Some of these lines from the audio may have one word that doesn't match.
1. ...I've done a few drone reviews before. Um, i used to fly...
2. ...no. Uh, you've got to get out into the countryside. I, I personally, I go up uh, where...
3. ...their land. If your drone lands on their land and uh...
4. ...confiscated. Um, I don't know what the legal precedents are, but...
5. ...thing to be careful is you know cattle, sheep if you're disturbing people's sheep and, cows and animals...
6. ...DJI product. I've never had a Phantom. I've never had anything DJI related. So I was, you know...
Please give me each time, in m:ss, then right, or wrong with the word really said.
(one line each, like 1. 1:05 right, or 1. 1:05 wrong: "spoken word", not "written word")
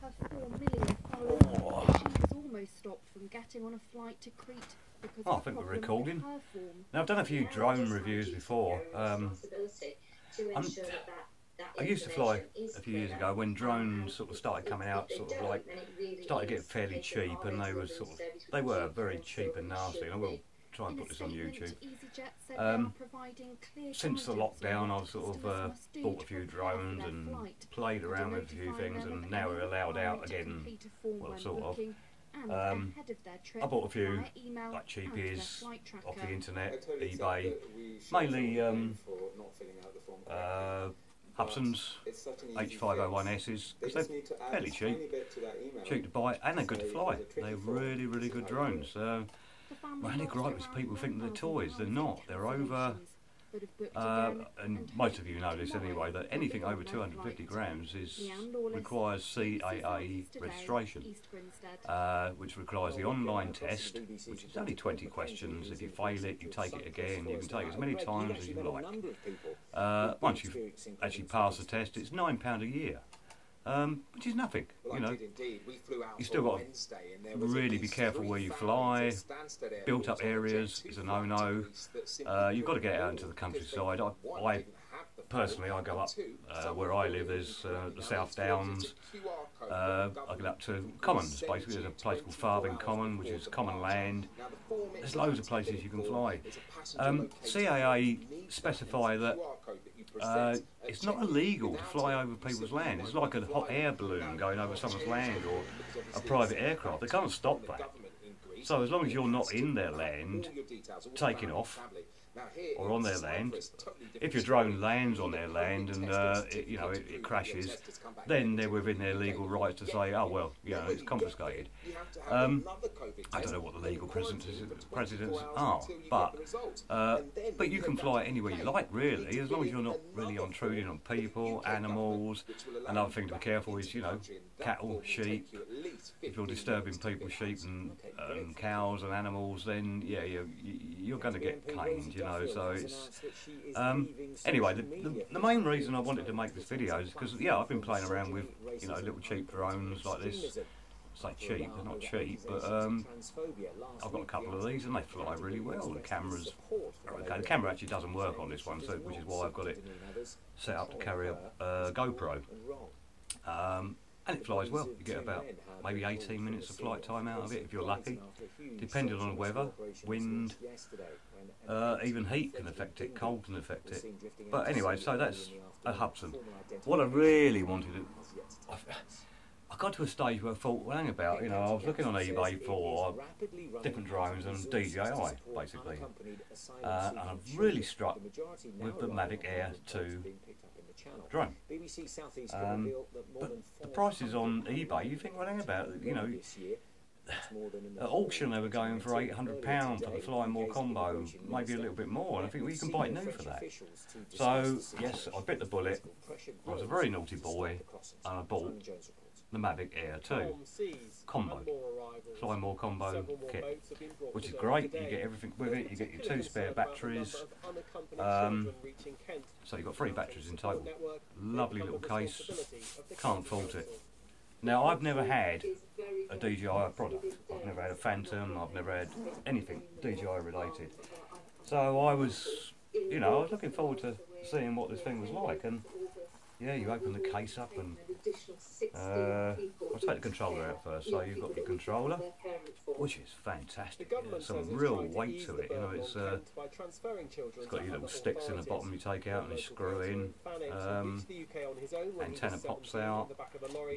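1. 0:07 right
2. 1:21 right
3. 1:53 right
4. 2:01 right
5. 2:13 right
6. 3:46 right.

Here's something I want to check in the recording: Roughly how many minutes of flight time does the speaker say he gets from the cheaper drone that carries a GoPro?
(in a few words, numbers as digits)
18.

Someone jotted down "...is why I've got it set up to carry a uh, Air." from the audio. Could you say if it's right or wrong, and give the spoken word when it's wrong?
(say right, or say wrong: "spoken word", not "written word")
wrong: "GoPro", not "Air".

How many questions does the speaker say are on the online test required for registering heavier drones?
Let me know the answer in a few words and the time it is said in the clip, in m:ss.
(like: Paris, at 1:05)
20, at 1:04.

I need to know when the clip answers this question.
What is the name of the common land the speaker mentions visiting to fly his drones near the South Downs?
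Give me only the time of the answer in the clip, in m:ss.
1:32.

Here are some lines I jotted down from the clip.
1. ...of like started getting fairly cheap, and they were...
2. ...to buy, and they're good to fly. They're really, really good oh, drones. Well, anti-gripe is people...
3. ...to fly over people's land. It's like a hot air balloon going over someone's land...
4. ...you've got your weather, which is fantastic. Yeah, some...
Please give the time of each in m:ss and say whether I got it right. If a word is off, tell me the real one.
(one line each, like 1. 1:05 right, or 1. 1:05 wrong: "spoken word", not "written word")
1. 0:15 right
2. 0:46 right
3. 1:41 right
4. 4:01 wrong: "controller", not "weather".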